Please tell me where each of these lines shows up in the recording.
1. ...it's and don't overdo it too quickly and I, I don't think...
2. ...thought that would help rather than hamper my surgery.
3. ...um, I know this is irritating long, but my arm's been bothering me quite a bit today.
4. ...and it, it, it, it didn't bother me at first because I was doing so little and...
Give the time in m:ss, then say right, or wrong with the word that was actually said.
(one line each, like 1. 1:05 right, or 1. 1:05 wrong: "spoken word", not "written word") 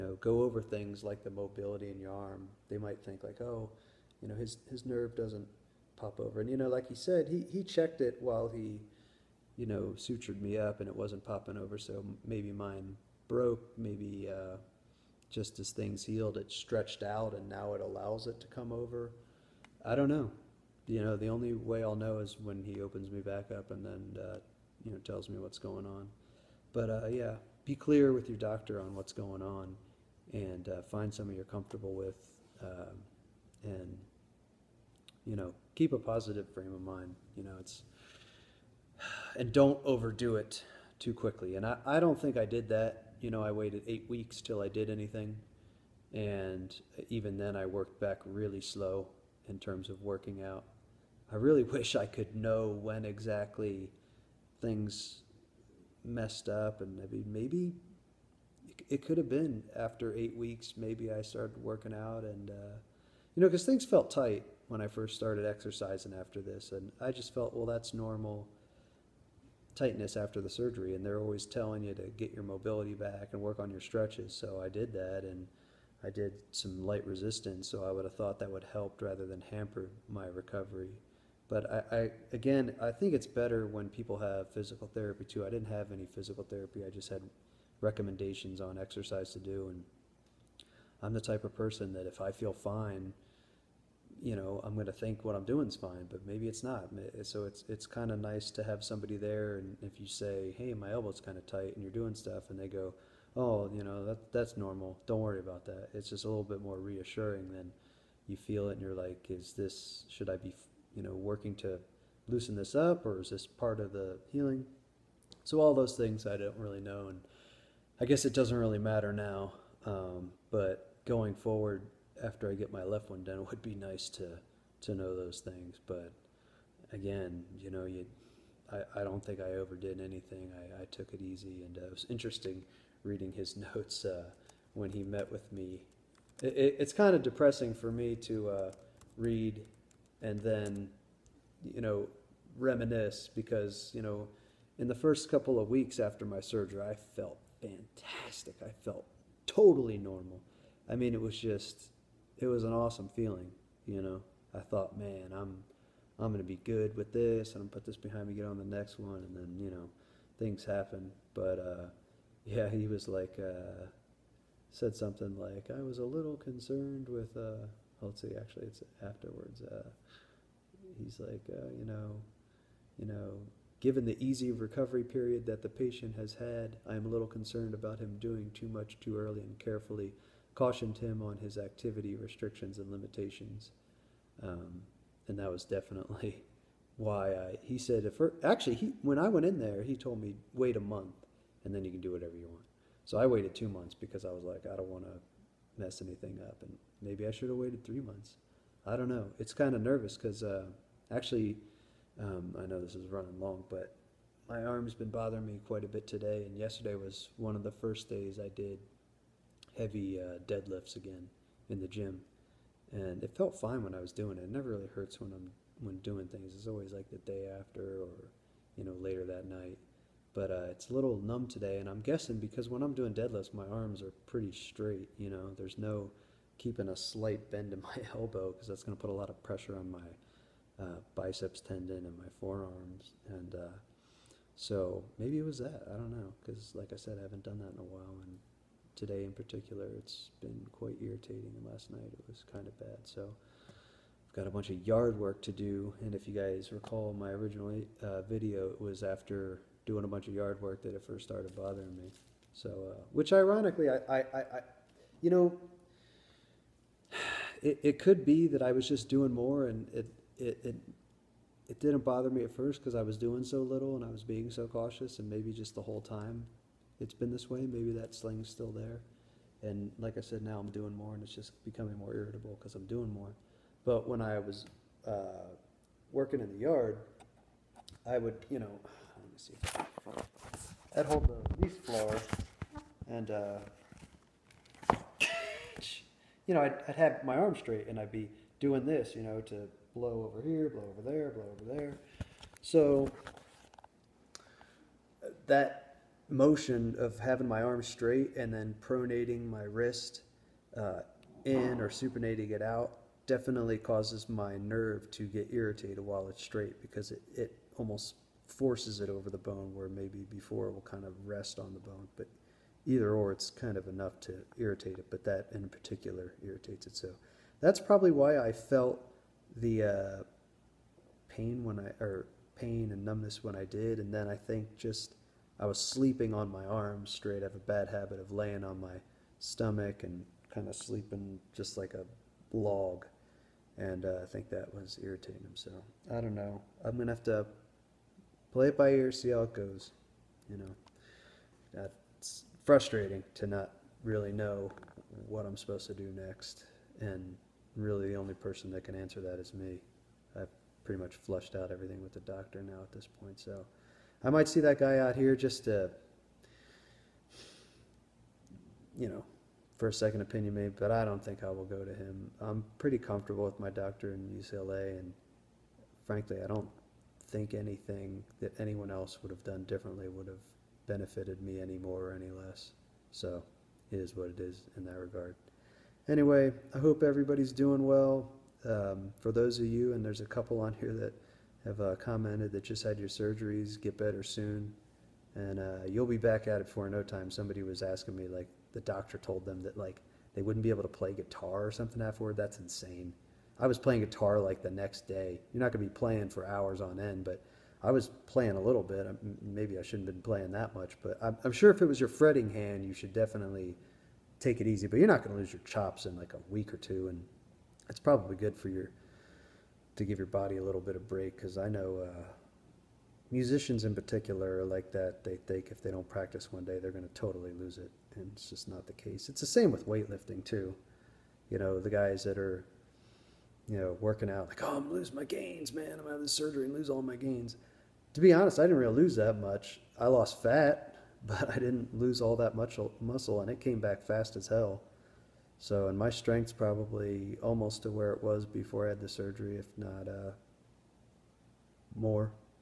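1. 0:37 right
2. 1:18 wrong: "recovery", not "surgery"
3. 3:22 wrong: "running", not "irritating"
4. 4:19 right.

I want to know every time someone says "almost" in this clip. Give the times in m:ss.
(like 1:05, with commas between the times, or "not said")
5:07, 7:17.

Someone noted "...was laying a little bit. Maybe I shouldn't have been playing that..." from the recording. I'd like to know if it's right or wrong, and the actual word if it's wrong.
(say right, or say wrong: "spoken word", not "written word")
wrong: "playing", not "laying".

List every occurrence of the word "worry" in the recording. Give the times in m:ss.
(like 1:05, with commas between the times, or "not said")
1:45.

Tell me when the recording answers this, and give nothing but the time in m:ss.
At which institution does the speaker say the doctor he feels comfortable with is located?
6:04.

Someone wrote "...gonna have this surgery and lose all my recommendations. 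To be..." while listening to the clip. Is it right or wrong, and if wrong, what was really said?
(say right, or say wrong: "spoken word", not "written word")
wrong: "gains", not "recommendations".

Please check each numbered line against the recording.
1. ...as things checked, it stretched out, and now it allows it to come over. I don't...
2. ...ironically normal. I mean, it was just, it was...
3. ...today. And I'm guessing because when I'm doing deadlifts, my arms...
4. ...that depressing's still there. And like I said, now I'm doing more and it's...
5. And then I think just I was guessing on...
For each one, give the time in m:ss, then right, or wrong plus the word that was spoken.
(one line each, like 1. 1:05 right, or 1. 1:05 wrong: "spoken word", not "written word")
1. 0:15 wrong: "healed", not "checked"
2. 2:29 wrong: "totally", not "ironically"
3. 3:41 right
4. 4:27 wrong: "sling", not "depressing"
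5. 5:23 wrong: "sleeping", not "guessing".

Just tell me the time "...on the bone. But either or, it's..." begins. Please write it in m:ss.
5:11.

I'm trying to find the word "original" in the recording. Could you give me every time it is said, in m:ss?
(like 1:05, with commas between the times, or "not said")
4:07.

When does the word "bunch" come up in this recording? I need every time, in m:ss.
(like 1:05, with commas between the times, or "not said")
4:04, 4:10.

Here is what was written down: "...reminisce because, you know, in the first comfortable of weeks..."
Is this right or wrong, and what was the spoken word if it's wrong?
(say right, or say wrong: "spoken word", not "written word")
wrong: "couple", not "comfortable".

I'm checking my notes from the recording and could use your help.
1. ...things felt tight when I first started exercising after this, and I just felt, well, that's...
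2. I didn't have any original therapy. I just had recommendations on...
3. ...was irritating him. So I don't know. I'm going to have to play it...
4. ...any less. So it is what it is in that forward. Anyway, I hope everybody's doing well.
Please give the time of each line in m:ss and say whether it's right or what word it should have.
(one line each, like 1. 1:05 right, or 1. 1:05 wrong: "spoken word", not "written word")
1. 1:03 right
2. 1:25 wrong: "physical", not "original"
3. 5:34 right
4. 6:12 wrong: "regard", not "forward".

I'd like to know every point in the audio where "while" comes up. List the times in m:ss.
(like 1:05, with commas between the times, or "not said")
0:08, 3:57, 5:06.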